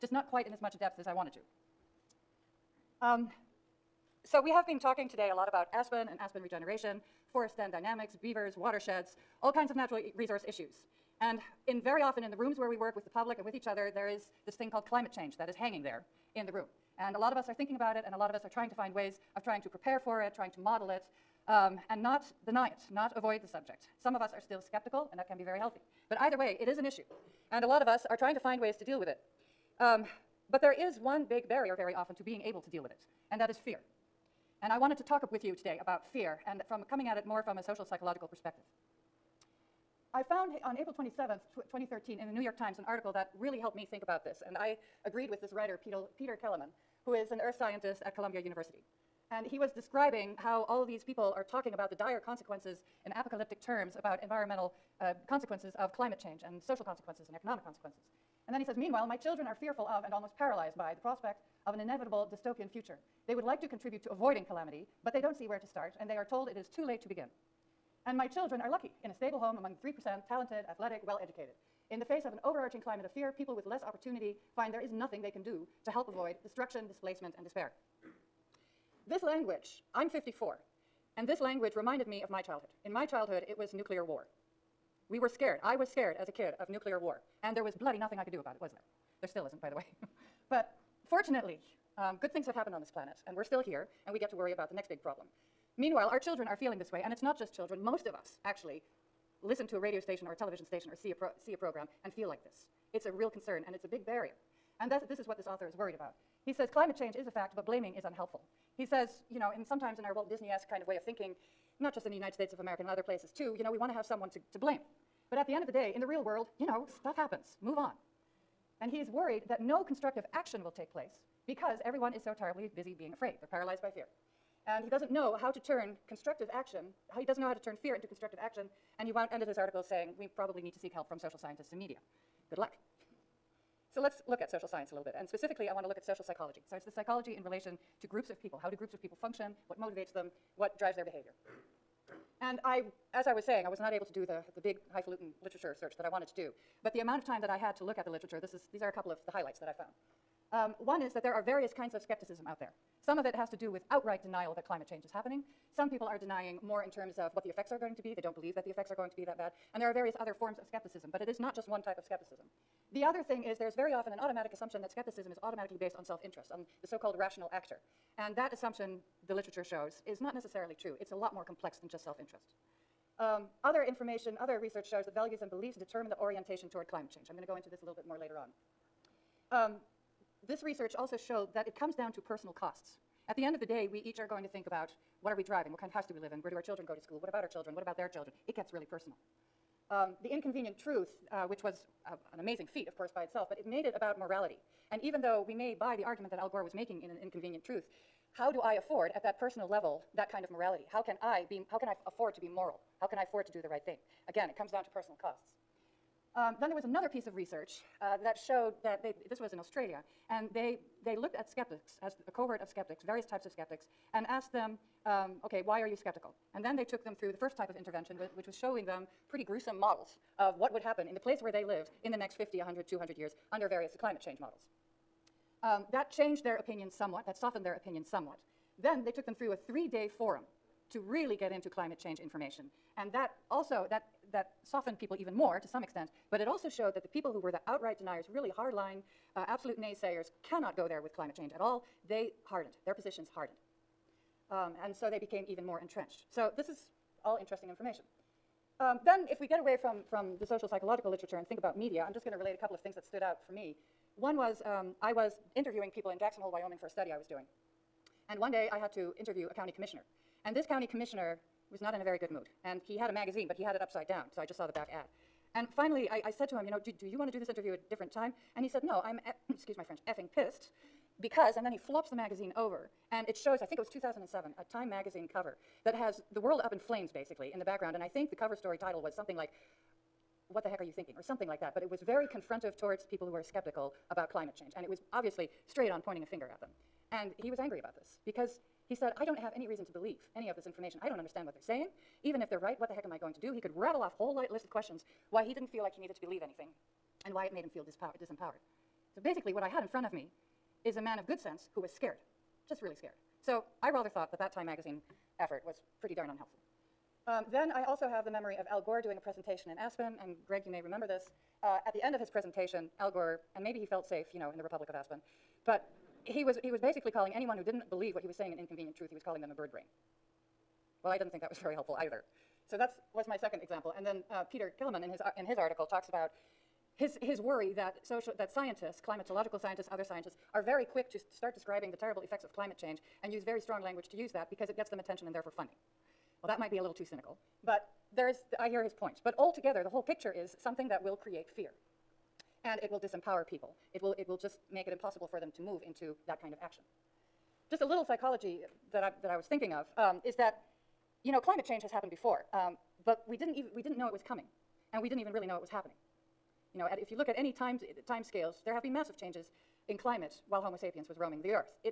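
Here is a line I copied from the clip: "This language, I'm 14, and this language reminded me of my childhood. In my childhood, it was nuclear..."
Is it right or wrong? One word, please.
wrong.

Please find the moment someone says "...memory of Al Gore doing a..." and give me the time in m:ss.
5:08.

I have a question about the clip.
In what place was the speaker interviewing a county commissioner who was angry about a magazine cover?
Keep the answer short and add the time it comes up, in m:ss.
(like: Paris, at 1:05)
Jackson Hole, Wyoming, at 4:16.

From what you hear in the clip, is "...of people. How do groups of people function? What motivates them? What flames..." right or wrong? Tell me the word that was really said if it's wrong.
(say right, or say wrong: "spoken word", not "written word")
wrong: "drives", not "flames".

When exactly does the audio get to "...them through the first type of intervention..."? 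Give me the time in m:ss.
3:37.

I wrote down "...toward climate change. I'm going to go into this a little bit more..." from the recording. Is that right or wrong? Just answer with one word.
right.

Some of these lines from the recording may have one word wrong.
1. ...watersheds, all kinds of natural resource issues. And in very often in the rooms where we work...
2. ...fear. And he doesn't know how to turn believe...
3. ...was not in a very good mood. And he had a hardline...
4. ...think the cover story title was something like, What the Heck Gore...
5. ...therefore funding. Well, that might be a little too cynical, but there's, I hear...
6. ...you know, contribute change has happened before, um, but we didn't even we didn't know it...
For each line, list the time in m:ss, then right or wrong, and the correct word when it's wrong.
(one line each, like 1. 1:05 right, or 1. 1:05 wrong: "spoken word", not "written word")
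1. 0:08 right
2. 2:03 wrong: "constructive", not "believe"
3. 4:21 wrong: "magazine", not "hardline"
4. 4:38 wrong: "Are", not "Gore"
5. 5:35 right
6. 5:51 wrong: "climate", not "contribute".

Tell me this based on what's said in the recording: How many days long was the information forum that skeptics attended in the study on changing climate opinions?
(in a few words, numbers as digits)
3.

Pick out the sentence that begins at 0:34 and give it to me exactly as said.
And I wanted to talk with you today about fear and from coming at it more from a social psychological perspective.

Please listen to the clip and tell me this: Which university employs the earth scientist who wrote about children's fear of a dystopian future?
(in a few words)
Columbia University.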